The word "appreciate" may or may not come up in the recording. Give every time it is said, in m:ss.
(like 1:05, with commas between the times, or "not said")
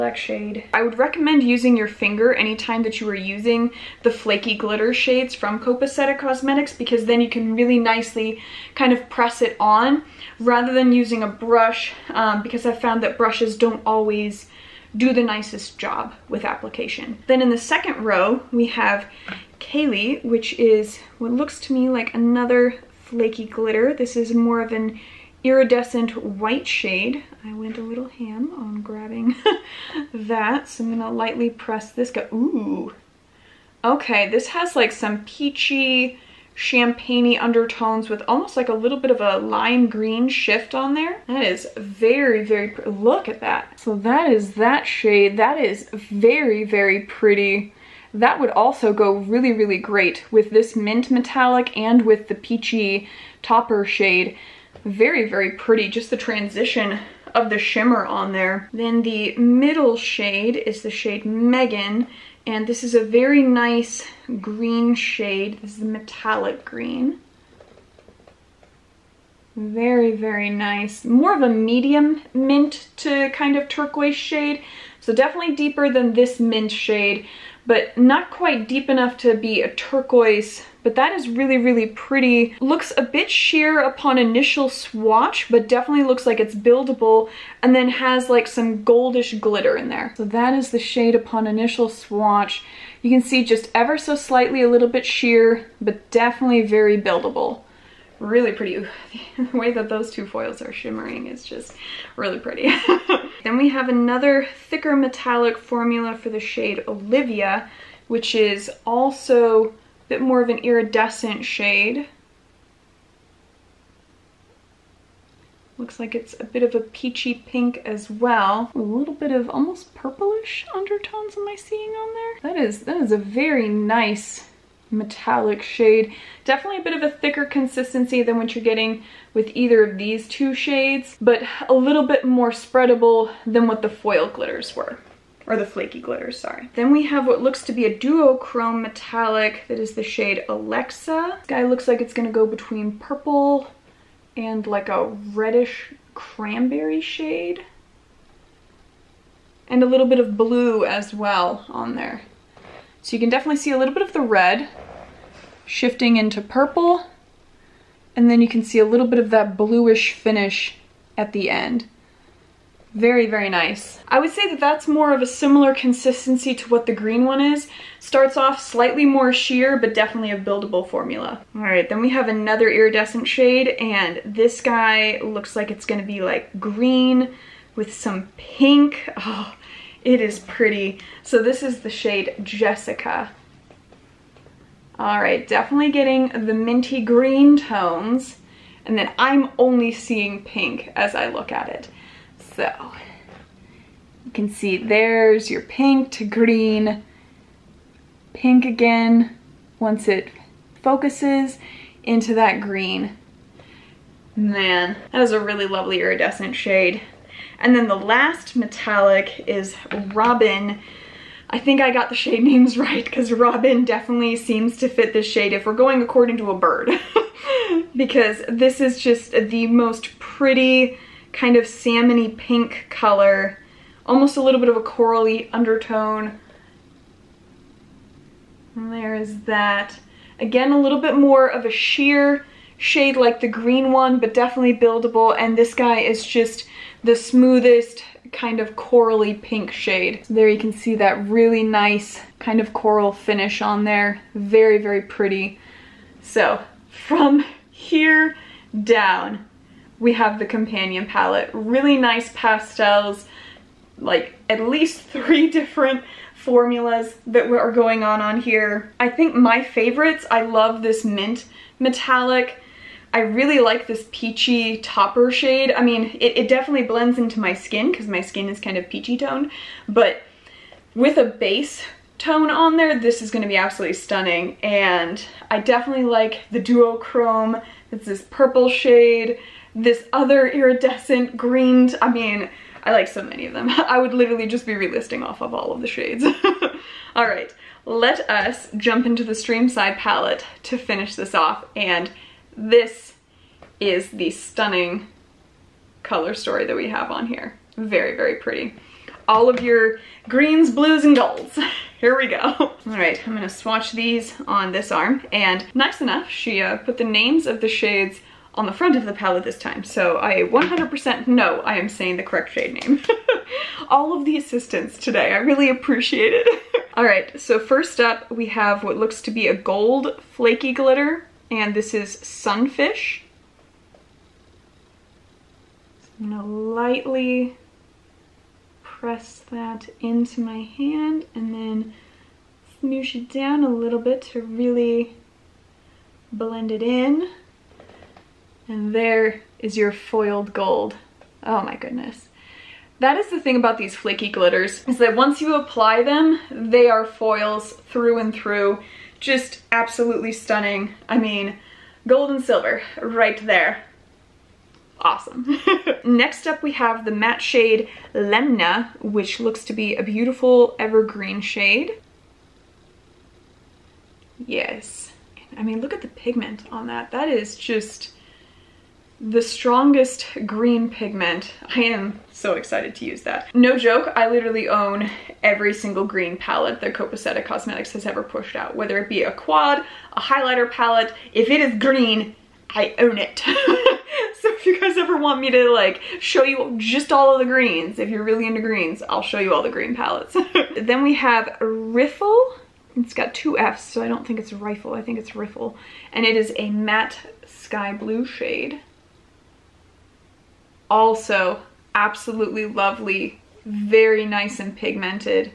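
5:15.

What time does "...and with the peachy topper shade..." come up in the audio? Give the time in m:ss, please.
0:51.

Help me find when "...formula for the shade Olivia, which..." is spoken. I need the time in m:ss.
1:45.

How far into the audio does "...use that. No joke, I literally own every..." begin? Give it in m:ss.
6:13.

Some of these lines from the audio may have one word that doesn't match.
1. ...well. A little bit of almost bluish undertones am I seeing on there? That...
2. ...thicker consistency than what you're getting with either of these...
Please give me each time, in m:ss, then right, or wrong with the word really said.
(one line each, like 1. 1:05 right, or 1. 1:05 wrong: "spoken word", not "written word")
1. 1:58 wrong: "purplish", not "bluish"
2. 2:07 right.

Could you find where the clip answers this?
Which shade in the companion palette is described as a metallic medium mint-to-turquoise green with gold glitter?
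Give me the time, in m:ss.
1:01.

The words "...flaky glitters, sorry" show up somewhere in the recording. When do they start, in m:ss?
2:15.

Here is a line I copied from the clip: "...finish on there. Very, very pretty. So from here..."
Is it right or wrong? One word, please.
right.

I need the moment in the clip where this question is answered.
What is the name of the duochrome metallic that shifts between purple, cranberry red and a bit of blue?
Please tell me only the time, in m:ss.
2:20.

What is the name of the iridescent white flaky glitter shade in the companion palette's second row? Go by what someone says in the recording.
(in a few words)
Kaylee.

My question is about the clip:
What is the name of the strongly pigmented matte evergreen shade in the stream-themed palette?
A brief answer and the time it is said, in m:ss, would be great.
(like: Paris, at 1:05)
Lemna, at 5:58.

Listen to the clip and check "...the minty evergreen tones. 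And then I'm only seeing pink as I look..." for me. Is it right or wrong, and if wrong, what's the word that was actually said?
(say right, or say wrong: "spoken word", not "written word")
wrong: "green", not "evergreen".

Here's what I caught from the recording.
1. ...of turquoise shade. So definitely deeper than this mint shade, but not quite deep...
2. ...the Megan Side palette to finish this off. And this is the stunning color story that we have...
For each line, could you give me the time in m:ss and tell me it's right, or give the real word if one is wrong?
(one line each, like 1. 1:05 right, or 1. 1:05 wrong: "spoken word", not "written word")
1. 1:13 right
2. 4:49 wrong: "Stream", not "Megan".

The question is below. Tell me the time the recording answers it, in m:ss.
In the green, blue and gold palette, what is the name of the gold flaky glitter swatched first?
5:22.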